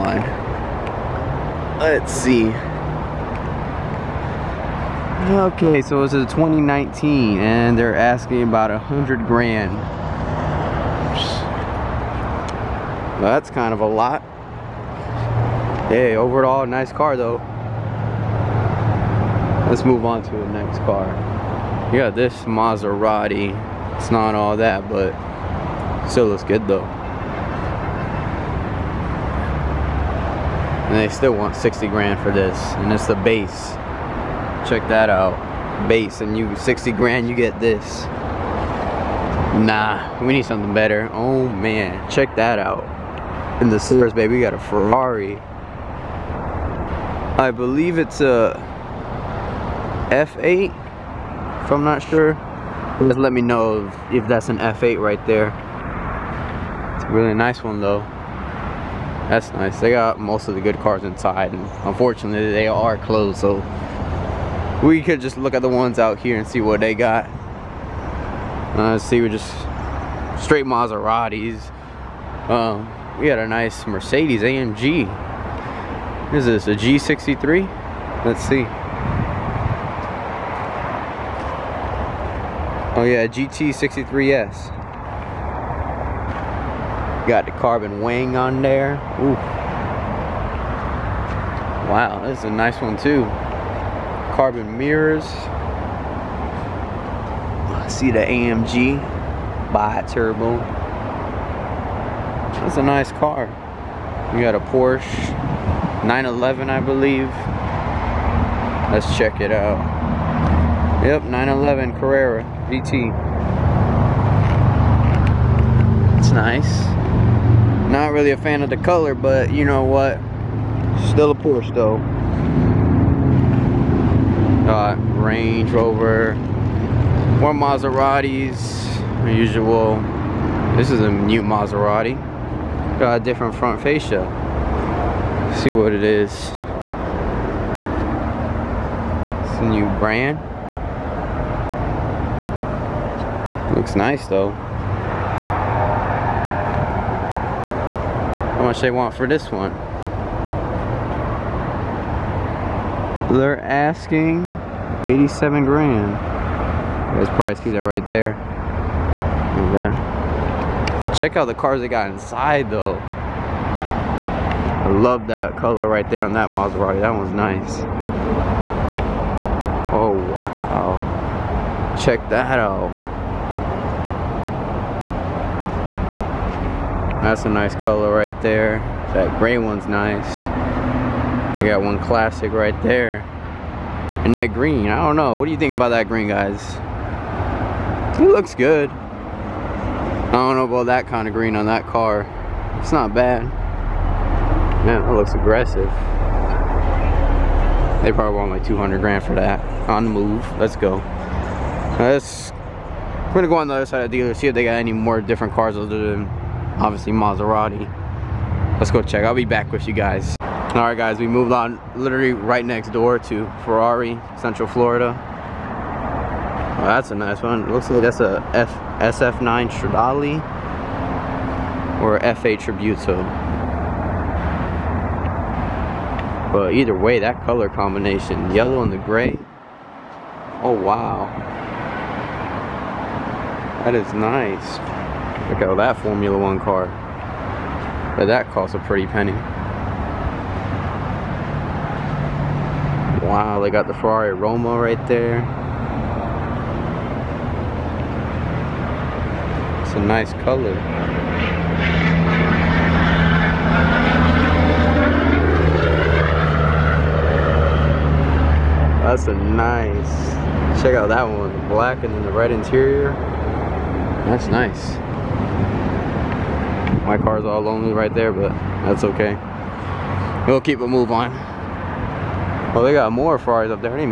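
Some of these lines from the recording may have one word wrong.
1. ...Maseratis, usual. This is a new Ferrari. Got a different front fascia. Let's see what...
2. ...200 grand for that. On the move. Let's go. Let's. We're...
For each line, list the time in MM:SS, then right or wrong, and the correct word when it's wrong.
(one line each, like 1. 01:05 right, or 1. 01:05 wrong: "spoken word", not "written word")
1. 02:07 wrong: "Maserati", not "Ferrari"
2. 03:18 right.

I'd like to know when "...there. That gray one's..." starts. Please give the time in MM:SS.
02:58.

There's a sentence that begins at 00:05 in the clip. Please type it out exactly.
Okay, so it's a 2019 and they're asking about a hundred grand.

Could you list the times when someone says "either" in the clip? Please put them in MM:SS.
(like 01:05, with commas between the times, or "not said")
03:46.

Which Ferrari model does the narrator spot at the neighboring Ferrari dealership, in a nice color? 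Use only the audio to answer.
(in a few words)
Ferrari Roma.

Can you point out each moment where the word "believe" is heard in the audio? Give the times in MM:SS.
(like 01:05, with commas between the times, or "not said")
00:47, 01:46.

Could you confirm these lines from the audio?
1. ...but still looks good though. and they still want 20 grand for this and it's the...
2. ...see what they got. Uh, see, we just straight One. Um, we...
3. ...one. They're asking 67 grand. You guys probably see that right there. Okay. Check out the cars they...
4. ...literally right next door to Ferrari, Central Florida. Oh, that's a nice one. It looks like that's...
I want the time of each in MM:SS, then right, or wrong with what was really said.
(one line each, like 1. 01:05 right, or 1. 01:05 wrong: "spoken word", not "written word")
1. 00:24 wrong: "60", not "20"
2. 01:06 wrong: "Maseratis", not "One"
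3. 02:29 wrong: "87", not "67"
4. 03:31 right.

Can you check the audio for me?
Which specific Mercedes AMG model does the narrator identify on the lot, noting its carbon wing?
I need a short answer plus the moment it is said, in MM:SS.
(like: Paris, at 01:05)
GT63S, at 01:23.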